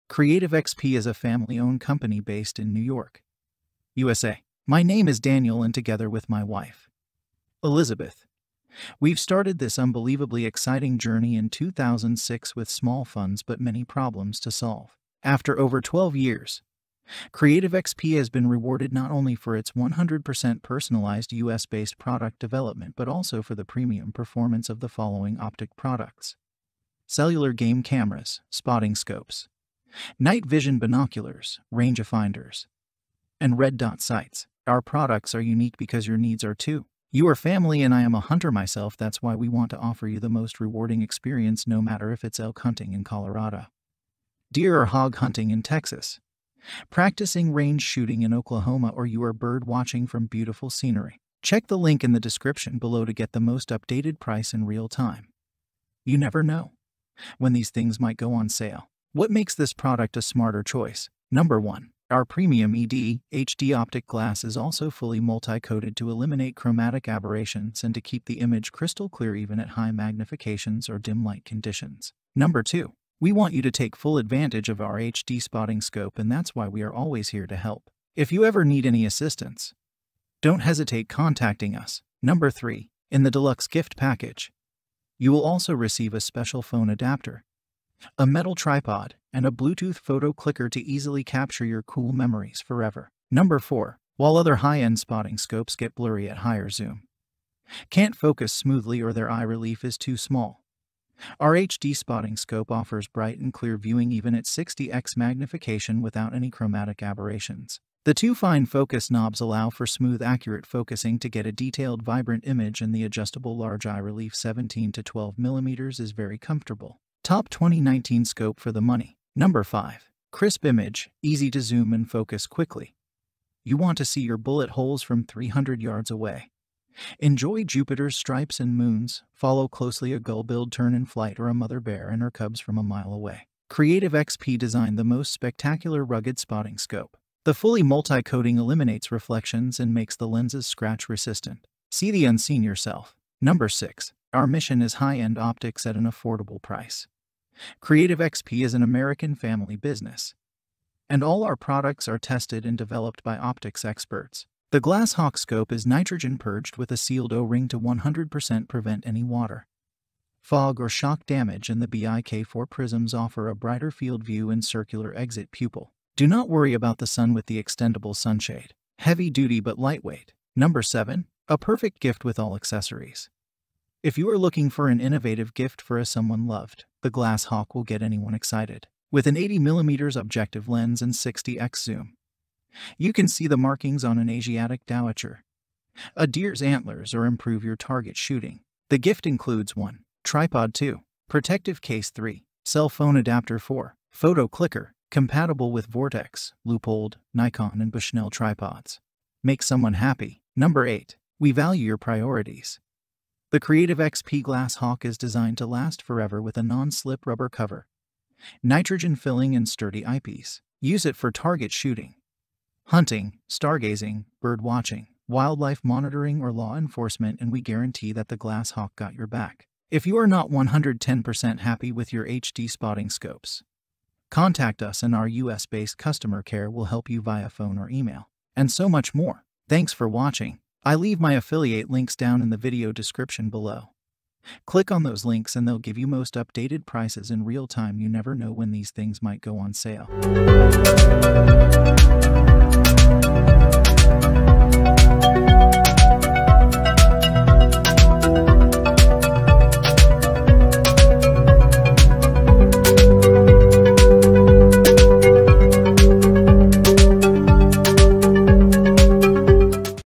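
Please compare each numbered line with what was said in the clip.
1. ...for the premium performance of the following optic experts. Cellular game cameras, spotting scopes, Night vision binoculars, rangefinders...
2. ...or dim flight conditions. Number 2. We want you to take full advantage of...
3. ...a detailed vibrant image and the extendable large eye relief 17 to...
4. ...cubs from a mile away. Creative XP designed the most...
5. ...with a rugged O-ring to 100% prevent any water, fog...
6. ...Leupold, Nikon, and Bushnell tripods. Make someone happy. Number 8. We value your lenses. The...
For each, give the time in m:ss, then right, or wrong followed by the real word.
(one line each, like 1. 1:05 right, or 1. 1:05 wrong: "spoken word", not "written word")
1. 0:23 wrong: "products", not "experts"
2. 1:10 wrong: "light", not "flight"
3. 1:51 wrong: "adjustable", not "extendable"
4. 2:12 right
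5. 2:36 wrong: "sealed", not "rugged"
6. 3:16 wrong: "priorities", not "lenses".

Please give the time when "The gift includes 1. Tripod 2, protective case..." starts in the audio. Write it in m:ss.
3:08.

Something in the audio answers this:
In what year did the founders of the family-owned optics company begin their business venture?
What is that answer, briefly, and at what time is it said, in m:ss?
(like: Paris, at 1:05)
2006, at 0:11.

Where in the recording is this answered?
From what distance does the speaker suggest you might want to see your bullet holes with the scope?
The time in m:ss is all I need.
2:05.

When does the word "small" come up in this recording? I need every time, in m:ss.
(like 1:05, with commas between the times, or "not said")
0:12, 1:40.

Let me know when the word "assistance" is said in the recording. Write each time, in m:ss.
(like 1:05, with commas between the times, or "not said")
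1:19.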